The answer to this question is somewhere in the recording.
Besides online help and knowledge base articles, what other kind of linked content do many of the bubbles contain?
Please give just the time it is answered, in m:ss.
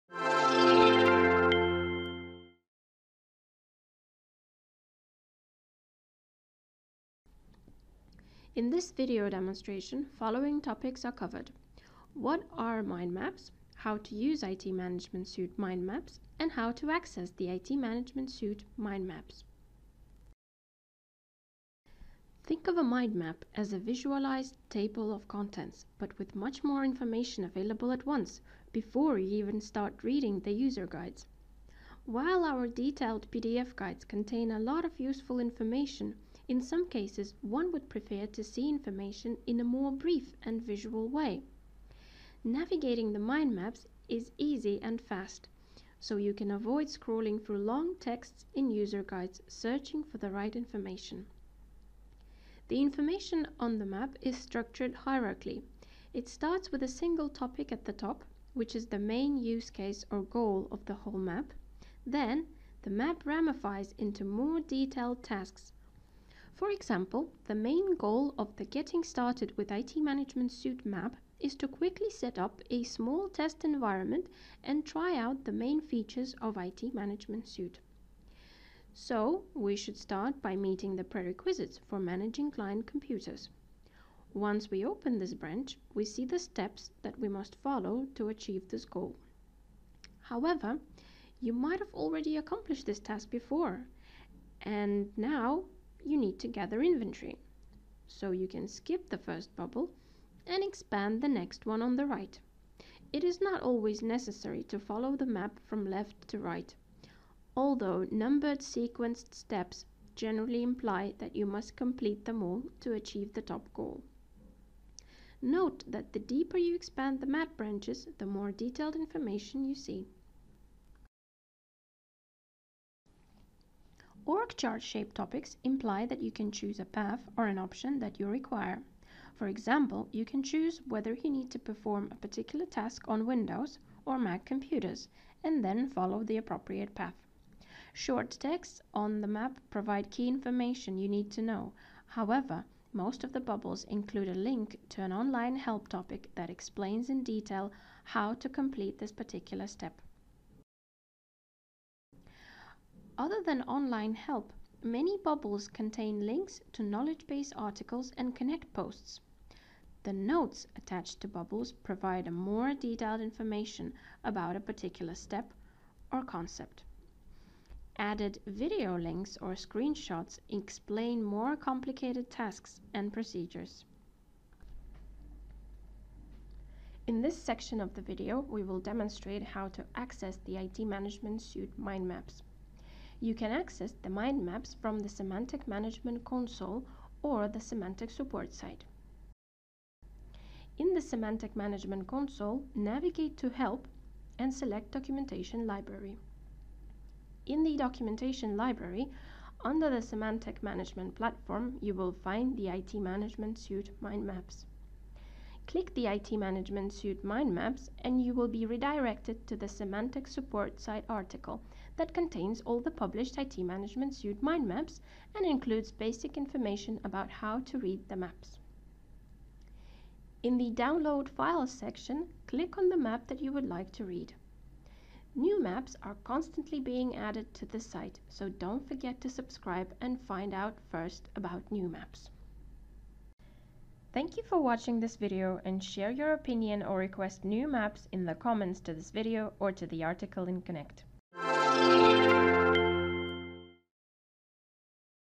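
2:38.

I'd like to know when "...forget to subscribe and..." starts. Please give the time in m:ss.
3:48.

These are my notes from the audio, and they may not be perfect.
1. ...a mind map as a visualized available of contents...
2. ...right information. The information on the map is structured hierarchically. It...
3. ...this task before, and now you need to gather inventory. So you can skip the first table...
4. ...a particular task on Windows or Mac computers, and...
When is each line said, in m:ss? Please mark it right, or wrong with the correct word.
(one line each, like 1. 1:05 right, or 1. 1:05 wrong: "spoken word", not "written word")
1. 0:22 wrong: "table", not "available"
2. 0:50 right
3. 1:32 wrong: "bubble", not "table"
4. 2:12 right.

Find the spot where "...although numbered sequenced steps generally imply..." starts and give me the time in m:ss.
1:47.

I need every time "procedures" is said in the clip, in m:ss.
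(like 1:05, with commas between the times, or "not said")
2:53.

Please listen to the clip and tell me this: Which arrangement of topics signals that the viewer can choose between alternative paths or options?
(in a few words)
Org chart.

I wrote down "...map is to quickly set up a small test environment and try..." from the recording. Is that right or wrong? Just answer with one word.
right.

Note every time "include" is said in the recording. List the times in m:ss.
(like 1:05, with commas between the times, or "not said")
2:23, 3:35.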